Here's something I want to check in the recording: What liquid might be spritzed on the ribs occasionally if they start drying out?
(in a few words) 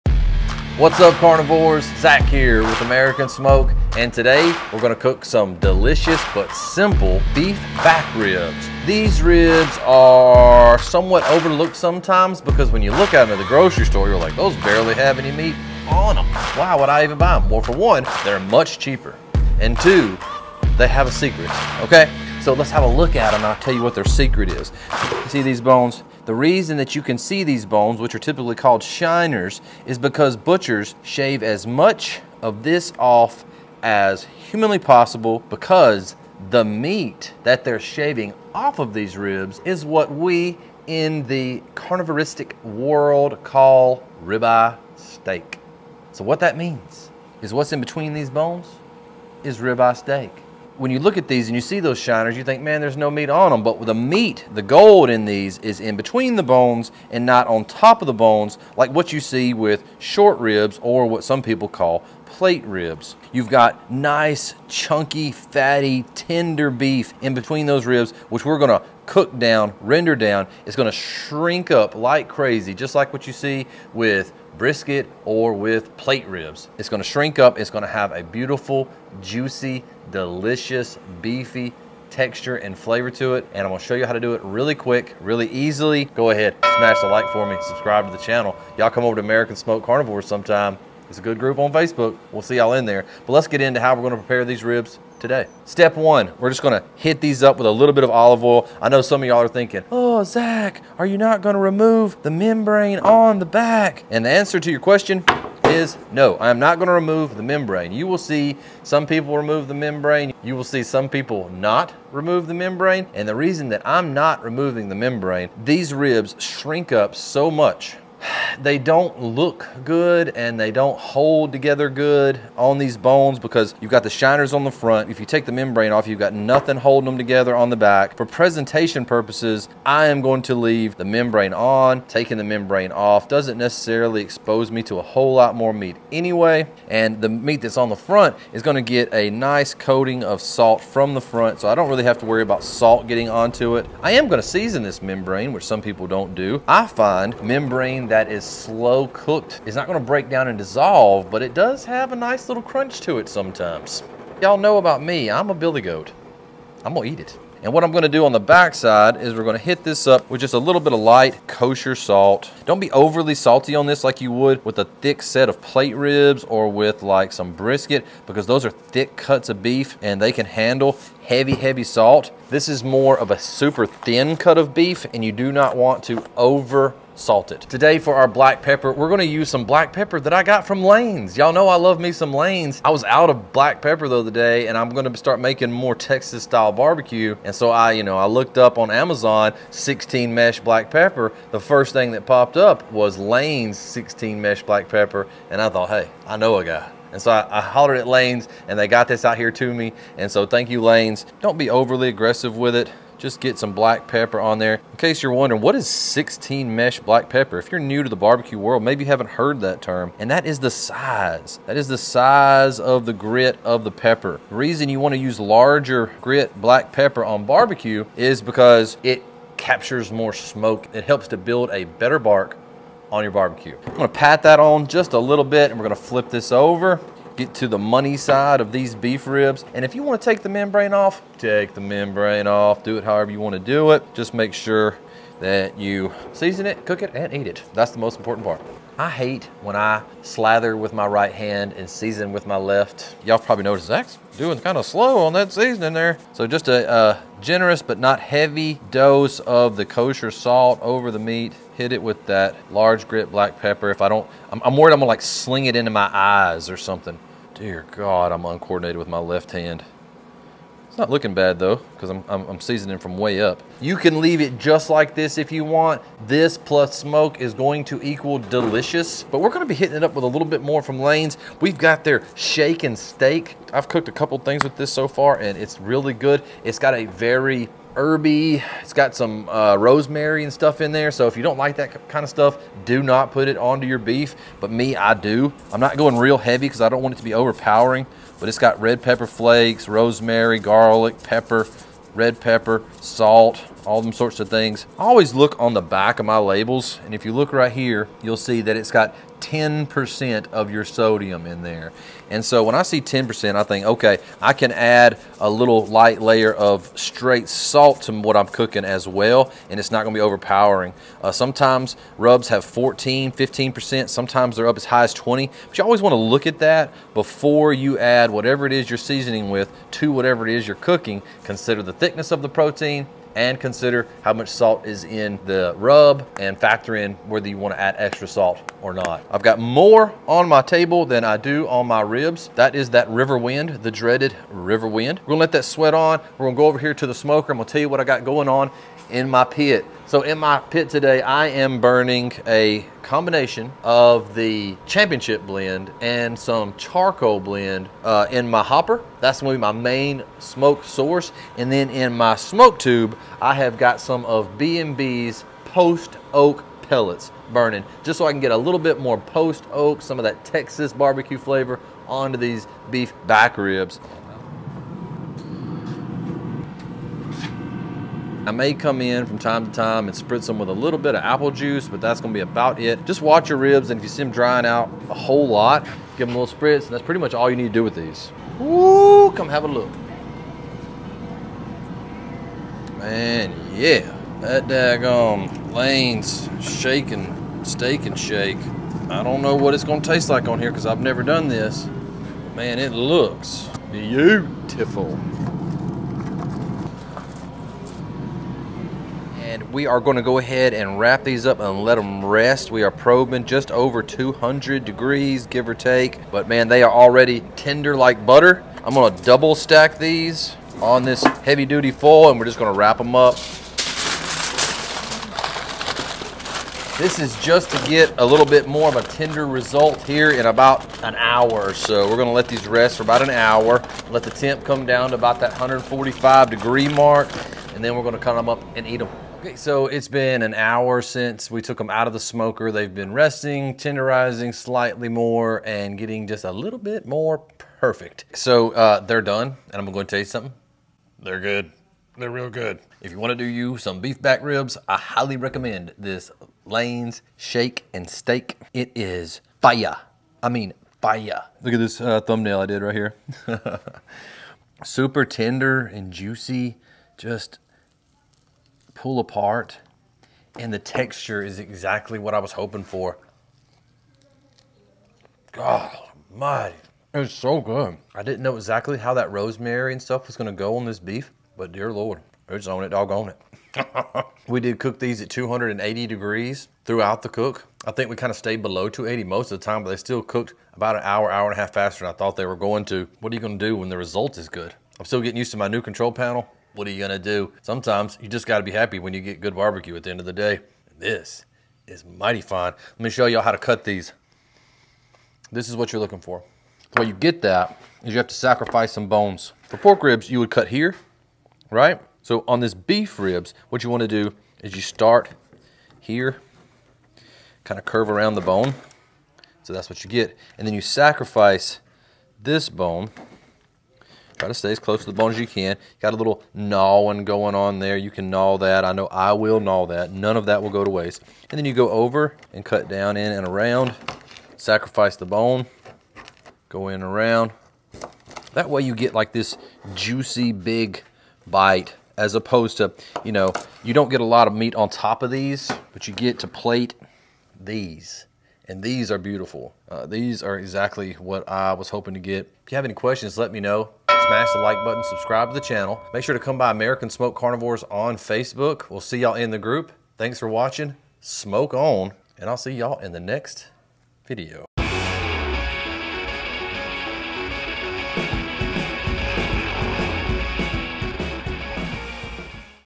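Apple juice.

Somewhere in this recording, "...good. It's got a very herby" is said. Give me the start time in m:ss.
4:36.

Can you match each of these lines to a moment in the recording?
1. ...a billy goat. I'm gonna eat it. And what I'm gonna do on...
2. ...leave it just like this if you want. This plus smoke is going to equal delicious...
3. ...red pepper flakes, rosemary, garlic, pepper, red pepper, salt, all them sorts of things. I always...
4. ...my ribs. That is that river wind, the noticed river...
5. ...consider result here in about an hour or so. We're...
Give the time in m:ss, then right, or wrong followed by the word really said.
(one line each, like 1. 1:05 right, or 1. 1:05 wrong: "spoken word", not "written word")
1. 2:35 right
2. 4:24 right
3. 4:48 right
4. 5:31 wrong: "dreaded", not "noticed"
5. 6:59 wrong: "tender", not "consider".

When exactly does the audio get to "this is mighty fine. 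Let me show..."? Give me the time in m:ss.
8:10.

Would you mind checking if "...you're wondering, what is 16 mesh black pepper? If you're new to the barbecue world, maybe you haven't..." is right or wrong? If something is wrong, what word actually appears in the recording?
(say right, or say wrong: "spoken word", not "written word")
right.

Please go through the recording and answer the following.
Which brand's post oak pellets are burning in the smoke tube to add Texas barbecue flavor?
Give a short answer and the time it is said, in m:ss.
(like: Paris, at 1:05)
B&B, at 5:54.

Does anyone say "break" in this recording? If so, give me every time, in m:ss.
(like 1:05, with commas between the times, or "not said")
2:29.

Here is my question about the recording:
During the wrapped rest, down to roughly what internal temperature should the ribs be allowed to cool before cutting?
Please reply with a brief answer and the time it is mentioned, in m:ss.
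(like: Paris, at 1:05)
145 degrees, at 7:05.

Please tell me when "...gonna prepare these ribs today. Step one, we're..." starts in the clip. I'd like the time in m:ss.
1:34.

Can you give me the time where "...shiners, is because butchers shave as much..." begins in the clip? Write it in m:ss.
0:28.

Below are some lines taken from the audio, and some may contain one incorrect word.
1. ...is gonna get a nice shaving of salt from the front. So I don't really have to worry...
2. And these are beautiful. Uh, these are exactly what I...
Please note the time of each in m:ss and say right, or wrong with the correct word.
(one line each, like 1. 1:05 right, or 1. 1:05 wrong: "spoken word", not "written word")
1. 2:18 wrong: "coating", not "shaving"
2. 8:58 right.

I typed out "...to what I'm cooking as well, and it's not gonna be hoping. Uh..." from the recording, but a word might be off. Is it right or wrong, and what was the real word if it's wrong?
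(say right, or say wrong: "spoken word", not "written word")
wrong: "overpowering", not "hoping".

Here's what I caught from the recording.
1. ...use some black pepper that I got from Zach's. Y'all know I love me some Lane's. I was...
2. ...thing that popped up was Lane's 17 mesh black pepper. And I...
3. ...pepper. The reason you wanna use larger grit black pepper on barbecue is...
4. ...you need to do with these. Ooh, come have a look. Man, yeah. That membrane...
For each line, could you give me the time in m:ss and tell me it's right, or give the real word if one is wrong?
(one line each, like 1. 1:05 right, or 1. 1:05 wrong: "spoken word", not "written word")
1. 2:59 wrong: "Lane", not "Zach"
2. 3:11 wrong: "16", not "17"
3. 3:33 right
4. 6:17 wrong: "daggone", not "membrane".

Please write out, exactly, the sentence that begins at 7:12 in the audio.
They've been resting, tenderizing slightly more, and getting just a little bit more perfect.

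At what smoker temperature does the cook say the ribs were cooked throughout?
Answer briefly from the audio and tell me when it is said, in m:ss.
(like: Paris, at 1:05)
280 degrees, at 7:55.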